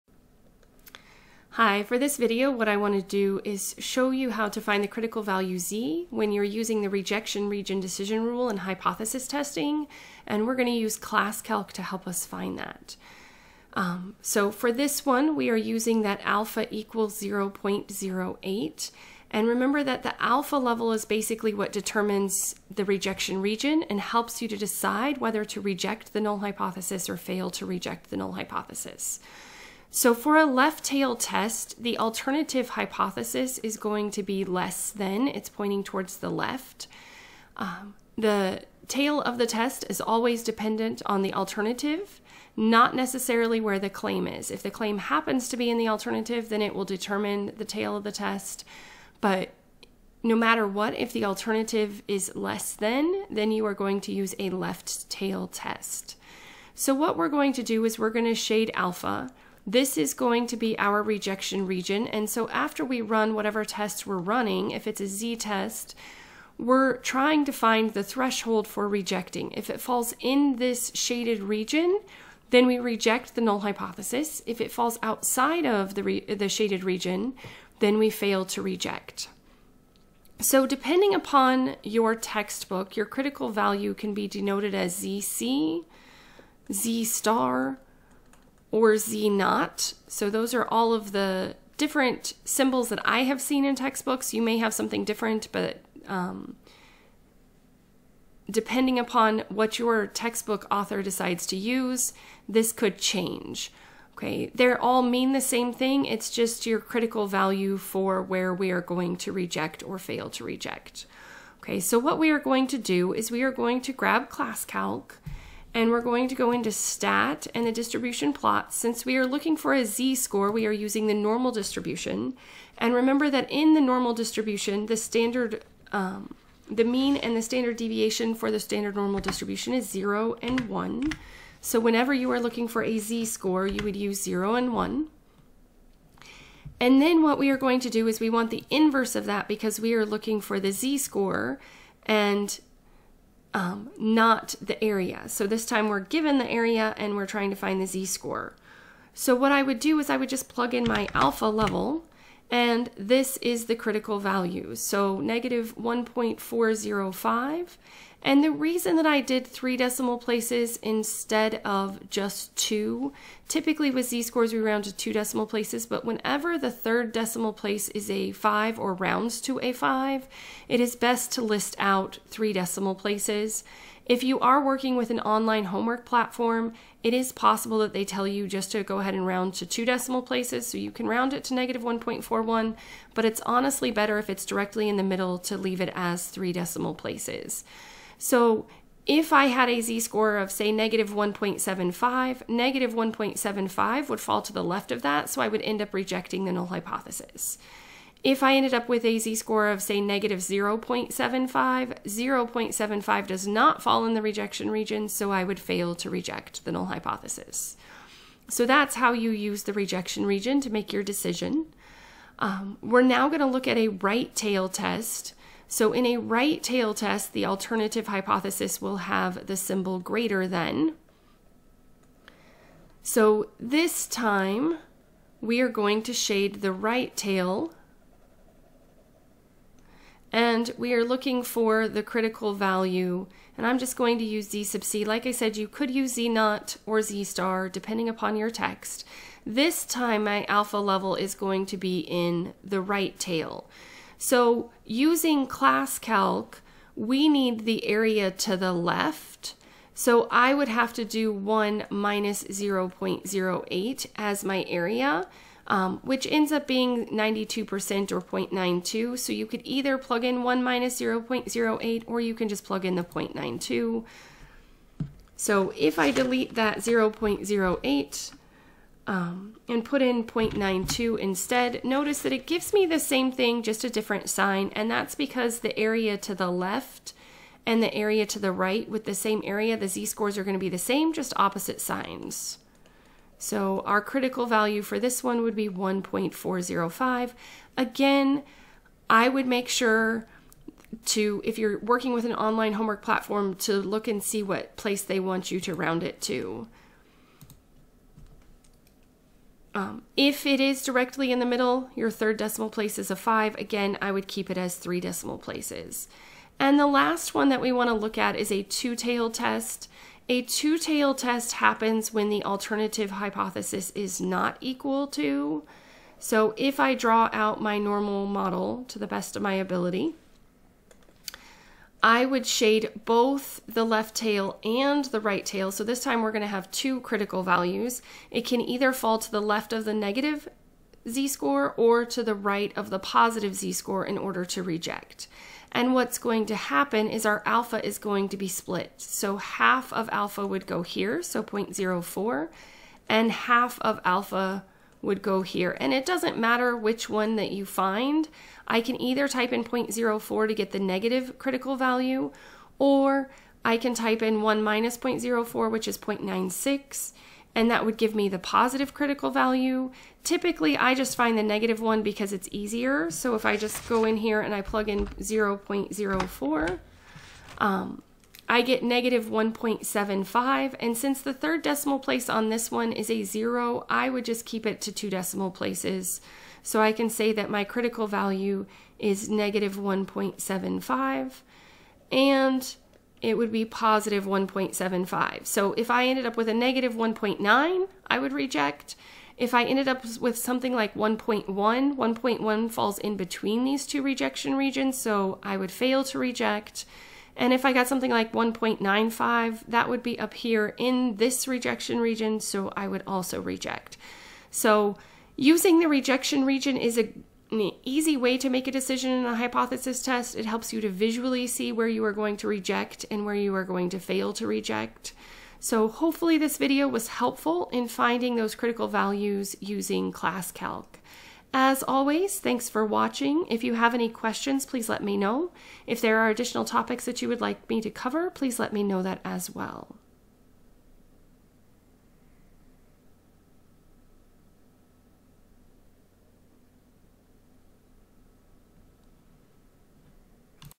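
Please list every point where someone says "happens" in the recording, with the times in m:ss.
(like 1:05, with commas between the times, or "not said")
0:44, 5:11, 5:36.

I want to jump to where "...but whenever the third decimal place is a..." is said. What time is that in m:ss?
2:45.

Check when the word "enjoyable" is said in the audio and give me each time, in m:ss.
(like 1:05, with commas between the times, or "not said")
not said.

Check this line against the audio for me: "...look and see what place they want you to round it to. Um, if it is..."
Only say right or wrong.
right.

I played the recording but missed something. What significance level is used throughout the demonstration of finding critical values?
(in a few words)
0.08.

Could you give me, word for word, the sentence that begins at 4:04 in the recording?
So using ClassCalc, we need the area to the left.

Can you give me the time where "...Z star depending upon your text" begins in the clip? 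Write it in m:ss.
3:57.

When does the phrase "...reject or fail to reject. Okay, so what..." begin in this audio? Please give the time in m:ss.
1:49.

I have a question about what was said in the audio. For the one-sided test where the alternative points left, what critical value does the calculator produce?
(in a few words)
-1.405.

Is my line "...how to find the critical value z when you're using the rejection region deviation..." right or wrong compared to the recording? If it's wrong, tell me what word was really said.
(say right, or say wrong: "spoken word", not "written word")
wrong: "decision", not "deviation".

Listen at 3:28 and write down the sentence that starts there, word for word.
So that's how you use the rejection region to make your decision.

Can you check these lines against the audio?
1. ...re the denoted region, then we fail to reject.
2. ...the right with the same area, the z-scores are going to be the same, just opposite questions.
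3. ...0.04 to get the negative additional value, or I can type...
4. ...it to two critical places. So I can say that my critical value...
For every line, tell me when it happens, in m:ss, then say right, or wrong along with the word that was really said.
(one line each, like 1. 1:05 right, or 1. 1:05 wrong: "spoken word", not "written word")
1. 1:16 wrong: "shaded", not "denoted"
2. 4:38 wrong: "signs", not "questions"
3. 5:49 wrong: "critical", not "additional"
4. 6:14 wrong: "decimal", not "critical".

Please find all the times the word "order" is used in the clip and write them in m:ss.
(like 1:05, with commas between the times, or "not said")
5:34.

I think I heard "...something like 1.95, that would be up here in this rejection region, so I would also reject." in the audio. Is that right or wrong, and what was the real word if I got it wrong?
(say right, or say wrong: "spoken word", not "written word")
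right.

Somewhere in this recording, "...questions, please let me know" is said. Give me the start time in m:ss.
7:04.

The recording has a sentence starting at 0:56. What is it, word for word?
So what we're going to do is we're going to shade alpha.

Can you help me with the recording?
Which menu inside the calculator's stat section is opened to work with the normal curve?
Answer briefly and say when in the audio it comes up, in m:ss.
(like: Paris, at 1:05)
distribution plot, at 1:57.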